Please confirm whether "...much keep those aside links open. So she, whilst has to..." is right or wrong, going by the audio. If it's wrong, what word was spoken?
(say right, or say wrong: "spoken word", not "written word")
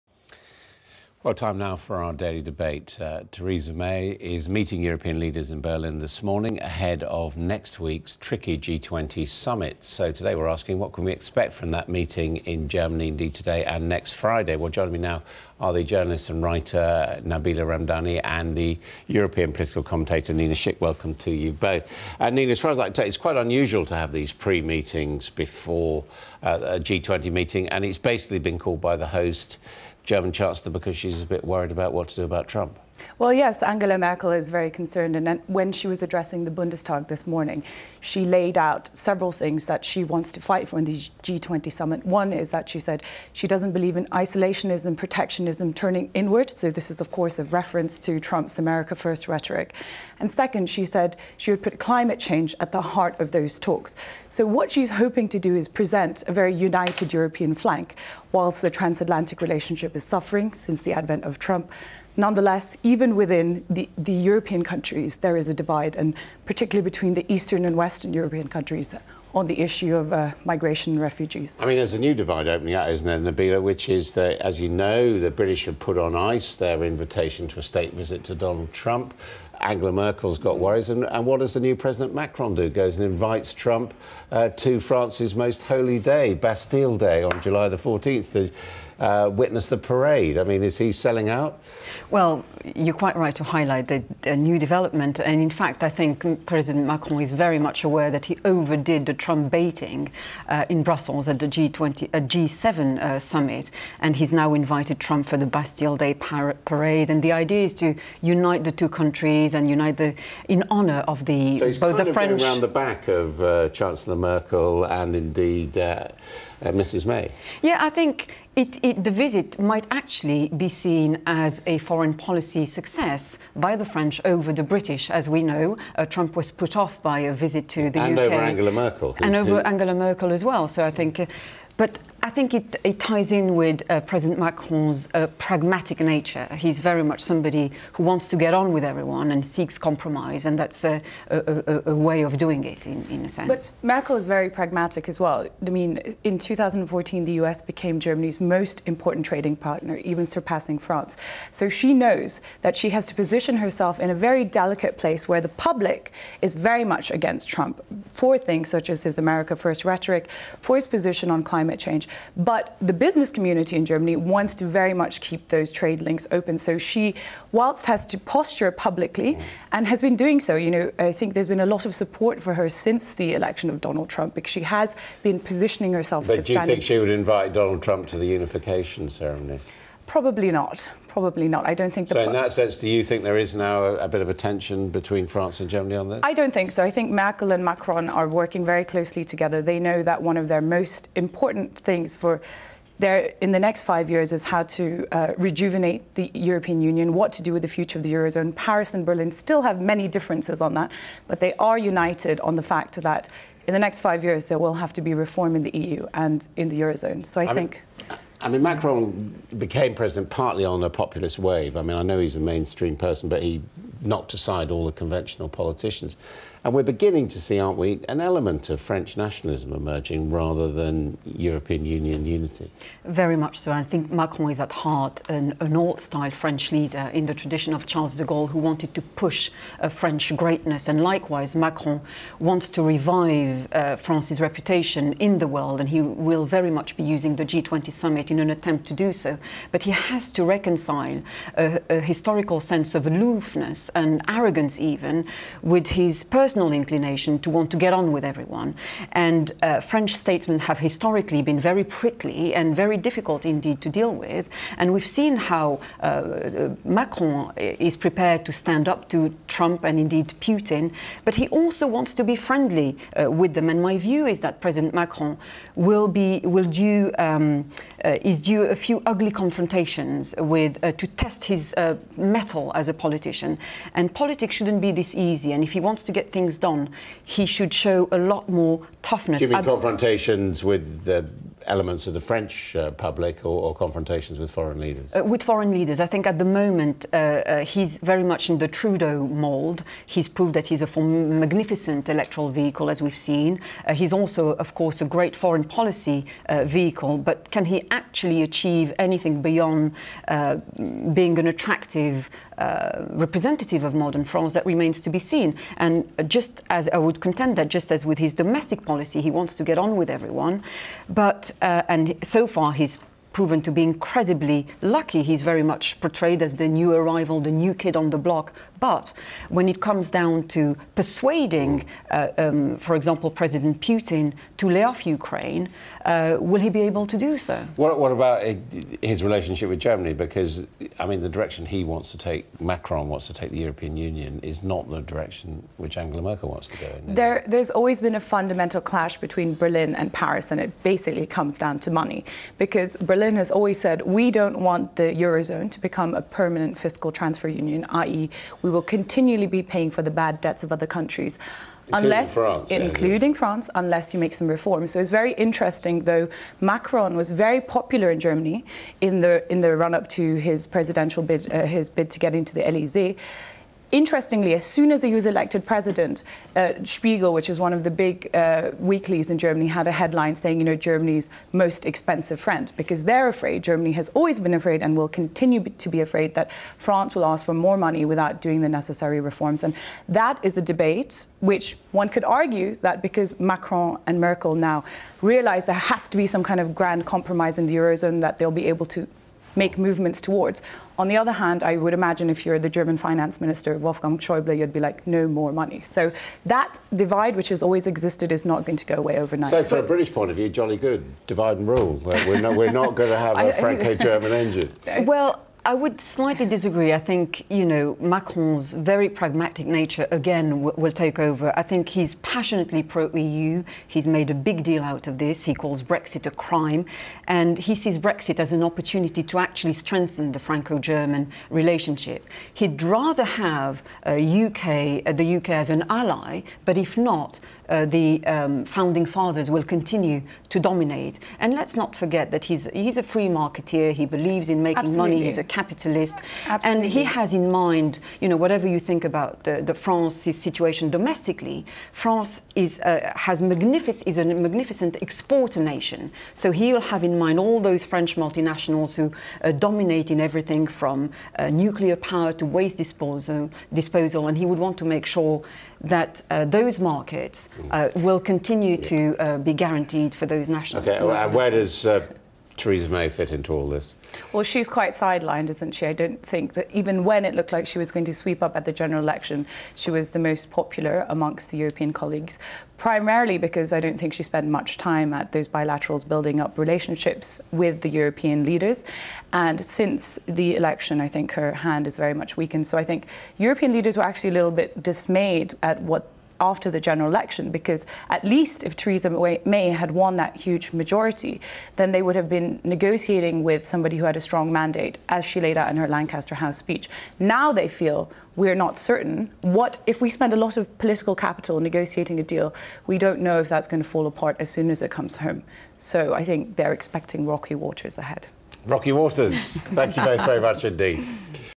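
wrong: "trade", not "aside".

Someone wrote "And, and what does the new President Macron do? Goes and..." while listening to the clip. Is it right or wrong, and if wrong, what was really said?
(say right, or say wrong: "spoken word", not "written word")
right.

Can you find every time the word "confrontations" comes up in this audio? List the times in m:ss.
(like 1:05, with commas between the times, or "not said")
4:29, 4:39, 4:43.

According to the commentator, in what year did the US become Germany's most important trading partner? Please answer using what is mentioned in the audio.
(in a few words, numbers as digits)
2014.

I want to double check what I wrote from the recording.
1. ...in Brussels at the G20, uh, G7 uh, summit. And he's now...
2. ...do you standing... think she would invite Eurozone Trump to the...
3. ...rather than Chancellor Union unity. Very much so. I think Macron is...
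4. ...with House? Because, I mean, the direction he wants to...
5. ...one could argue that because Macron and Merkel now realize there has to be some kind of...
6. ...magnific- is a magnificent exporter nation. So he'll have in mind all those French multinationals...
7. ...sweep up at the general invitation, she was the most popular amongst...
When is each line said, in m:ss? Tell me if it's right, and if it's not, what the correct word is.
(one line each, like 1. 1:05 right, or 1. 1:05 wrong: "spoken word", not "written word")
1. 1:40 right
2. 2:56 wrong: "Donald", not "Eurozone"
3. 3:40 wrong: "European", not "Chancellor"
4. 5:29 wrong: "Germany", not "House"
5. 6:21 right
6. 7:23 right
7. 7:48 wrong: "election", not "invitation".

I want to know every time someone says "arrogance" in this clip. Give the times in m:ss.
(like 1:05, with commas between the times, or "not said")
4:04.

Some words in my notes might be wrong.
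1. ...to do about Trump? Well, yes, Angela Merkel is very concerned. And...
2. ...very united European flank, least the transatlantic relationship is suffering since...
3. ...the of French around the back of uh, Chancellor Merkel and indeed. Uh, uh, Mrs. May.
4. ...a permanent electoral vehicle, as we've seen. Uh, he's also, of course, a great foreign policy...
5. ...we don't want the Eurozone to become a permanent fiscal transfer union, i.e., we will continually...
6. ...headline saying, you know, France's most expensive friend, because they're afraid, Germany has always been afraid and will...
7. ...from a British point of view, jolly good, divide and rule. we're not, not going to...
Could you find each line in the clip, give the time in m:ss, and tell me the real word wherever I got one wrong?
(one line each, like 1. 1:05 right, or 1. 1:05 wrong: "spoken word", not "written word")
1. 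0:32 right
2. 0:56 wrong: "whilst", not "least"
3. 1:52 right
4. 4:50 wrong: "magnificent", not "permanent"
5. 5:44 right
6. 6:09 wrong: "Germany", not "France"
7. 6:39 right.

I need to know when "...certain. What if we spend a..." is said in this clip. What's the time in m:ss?
8:18.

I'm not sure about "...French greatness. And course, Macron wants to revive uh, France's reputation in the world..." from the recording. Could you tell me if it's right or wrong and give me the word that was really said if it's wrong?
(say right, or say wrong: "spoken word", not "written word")
wrong: "likewise", not "course".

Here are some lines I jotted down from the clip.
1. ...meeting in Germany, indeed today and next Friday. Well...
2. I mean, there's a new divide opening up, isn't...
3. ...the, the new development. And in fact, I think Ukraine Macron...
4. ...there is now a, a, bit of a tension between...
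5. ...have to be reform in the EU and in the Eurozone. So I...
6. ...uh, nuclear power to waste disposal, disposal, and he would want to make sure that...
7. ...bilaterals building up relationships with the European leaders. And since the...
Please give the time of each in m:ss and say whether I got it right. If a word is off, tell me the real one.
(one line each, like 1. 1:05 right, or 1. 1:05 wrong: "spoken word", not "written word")
1. 0:11 right
2. 1:11 right
3. 1:33 wrong: "President", not "Ukraine"
4. 3:03 right
5. 3:24 right
6. 7:31 right
7. 7:55 right.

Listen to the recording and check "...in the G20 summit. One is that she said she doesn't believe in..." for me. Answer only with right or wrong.
right.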